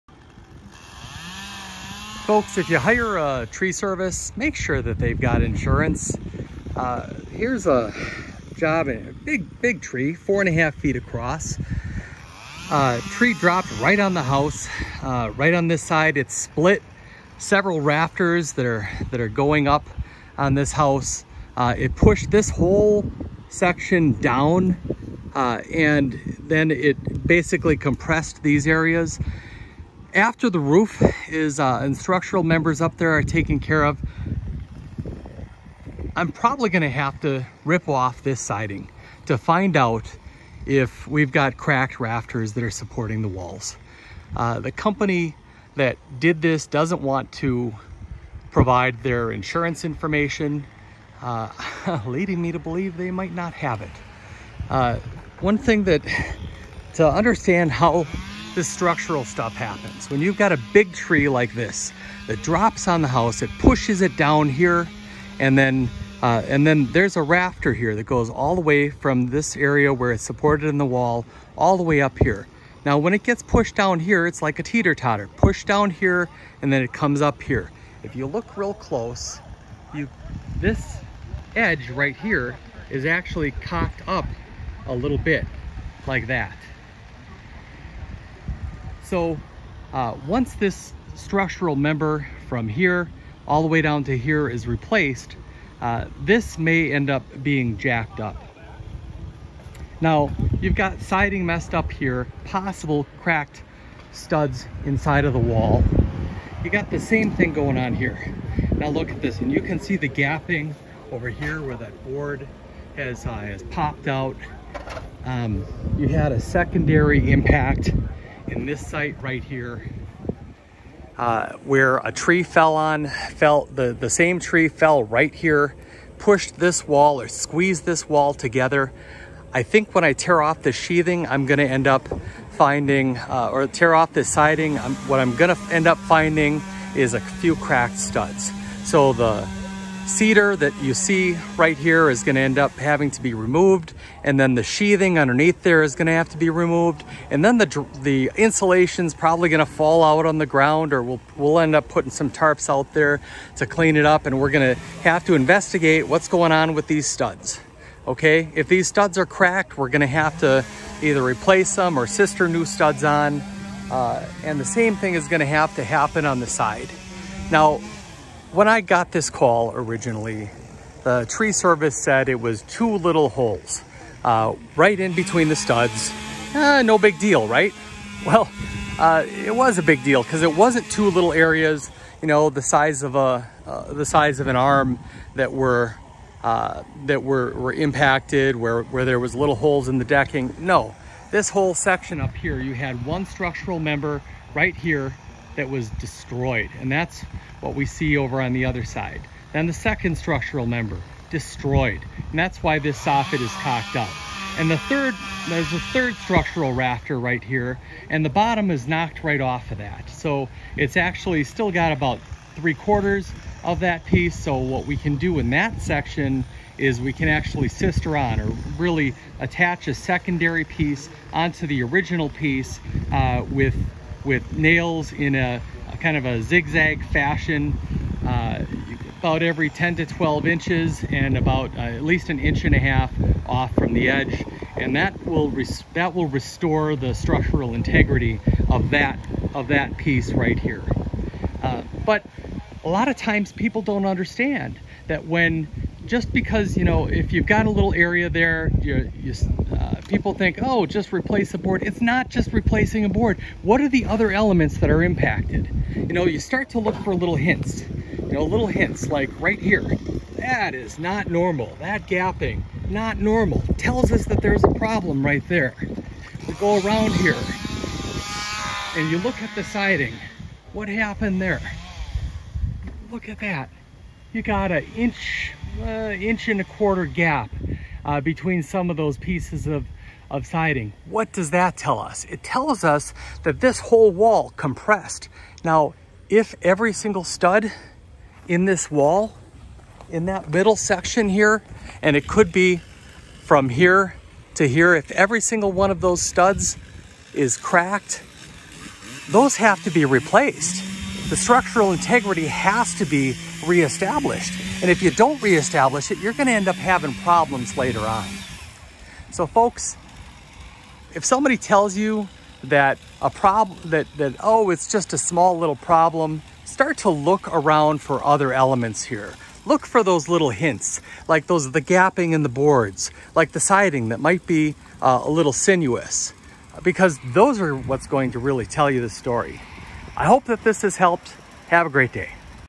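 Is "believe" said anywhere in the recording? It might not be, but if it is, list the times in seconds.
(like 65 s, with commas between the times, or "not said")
52 s.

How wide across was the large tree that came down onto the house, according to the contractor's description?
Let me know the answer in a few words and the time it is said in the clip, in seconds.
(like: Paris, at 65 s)
4.5 feet, at 10 s.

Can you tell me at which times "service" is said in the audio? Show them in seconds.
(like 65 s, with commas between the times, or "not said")
3 s, 171 s.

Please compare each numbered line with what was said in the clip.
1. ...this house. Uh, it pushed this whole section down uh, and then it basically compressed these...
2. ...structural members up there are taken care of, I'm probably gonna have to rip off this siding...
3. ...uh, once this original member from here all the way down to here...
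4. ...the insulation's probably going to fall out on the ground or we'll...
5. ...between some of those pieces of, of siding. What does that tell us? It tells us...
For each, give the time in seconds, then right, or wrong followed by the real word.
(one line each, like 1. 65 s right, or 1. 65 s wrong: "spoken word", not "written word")
1. 20 s right
2. 31 s right
3. 89 s wrong: "structural", not "original"
4. 148 s right
5. 278 s right.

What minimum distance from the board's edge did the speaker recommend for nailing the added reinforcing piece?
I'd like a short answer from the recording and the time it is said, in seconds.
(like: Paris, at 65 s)
an inch and a half, at 232 s.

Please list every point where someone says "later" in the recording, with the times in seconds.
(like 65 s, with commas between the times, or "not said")
307 s.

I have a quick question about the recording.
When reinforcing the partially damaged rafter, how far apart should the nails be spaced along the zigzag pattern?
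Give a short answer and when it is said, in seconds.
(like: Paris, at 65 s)
10 to 12 inches, at 229 s.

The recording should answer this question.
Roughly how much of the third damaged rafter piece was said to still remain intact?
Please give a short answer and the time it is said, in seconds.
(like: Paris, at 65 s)
three quarters, at 212 s.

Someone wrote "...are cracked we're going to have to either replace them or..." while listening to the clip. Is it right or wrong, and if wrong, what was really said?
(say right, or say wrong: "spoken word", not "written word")
right.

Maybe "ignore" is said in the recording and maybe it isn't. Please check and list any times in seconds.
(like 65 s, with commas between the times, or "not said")
not said.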